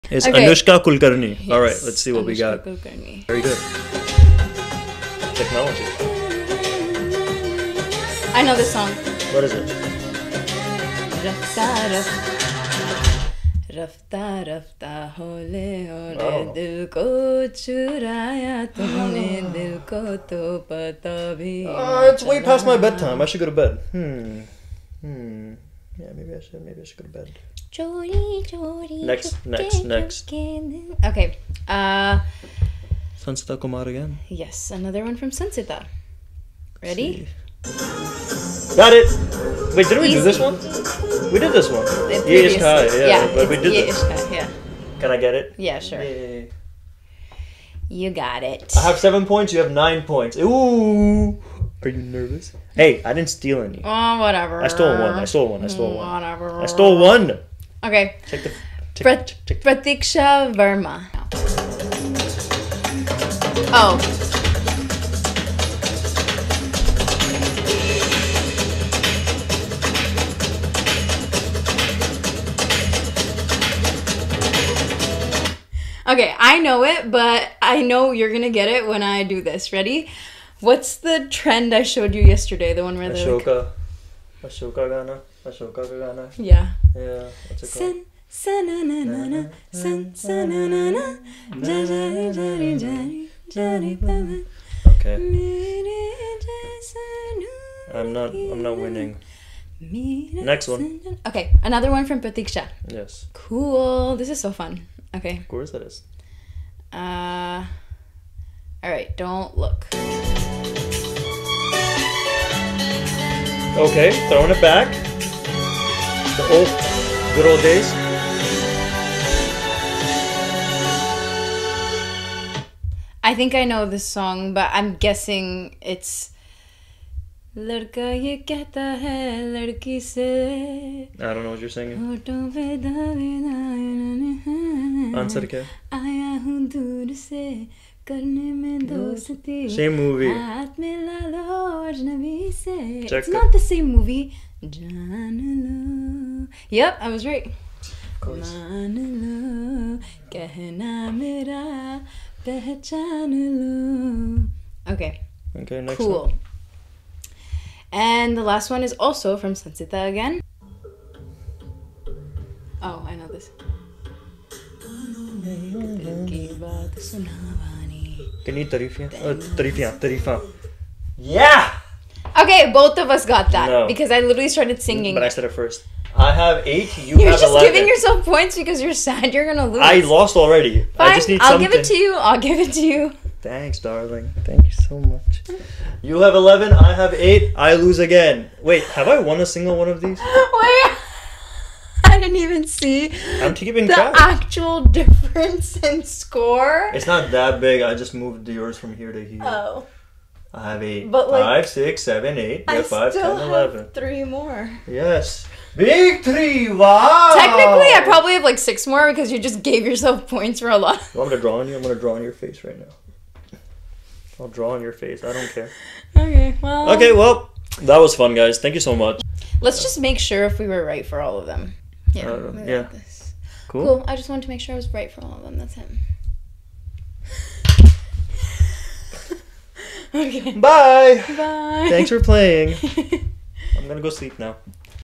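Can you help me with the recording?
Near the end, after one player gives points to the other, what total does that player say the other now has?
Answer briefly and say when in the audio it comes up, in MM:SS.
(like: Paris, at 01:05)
11, at 03:06.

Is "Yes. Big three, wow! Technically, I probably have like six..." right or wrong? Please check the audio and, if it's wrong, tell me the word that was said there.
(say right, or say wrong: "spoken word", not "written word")
right.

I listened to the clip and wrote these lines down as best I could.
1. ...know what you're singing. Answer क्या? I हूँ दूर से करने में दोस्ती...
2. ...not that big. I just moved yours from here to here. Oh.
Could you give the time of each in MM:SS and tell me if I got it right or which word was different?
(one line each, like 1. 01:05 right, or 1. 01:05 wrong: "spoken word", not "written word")
1. 02:11 right
2. 03:17 right.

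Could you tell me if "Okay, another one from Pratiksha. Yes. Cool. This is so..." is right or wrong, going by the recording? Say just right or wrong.
right.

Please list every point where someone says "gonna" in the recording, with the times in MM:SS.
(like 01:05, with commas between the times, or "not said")
01:18, 02:59, 03:53.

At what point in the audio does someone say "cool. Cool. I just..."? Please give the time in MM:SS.
03:43.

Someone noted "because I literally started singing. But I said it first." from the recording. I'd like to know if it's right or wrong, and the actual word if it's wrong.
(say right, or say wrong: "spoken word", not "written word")
right.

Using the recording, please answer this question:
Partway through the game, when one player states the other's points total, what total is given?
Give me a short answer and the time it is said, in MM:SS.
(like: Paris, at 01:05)
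9, at 00:49.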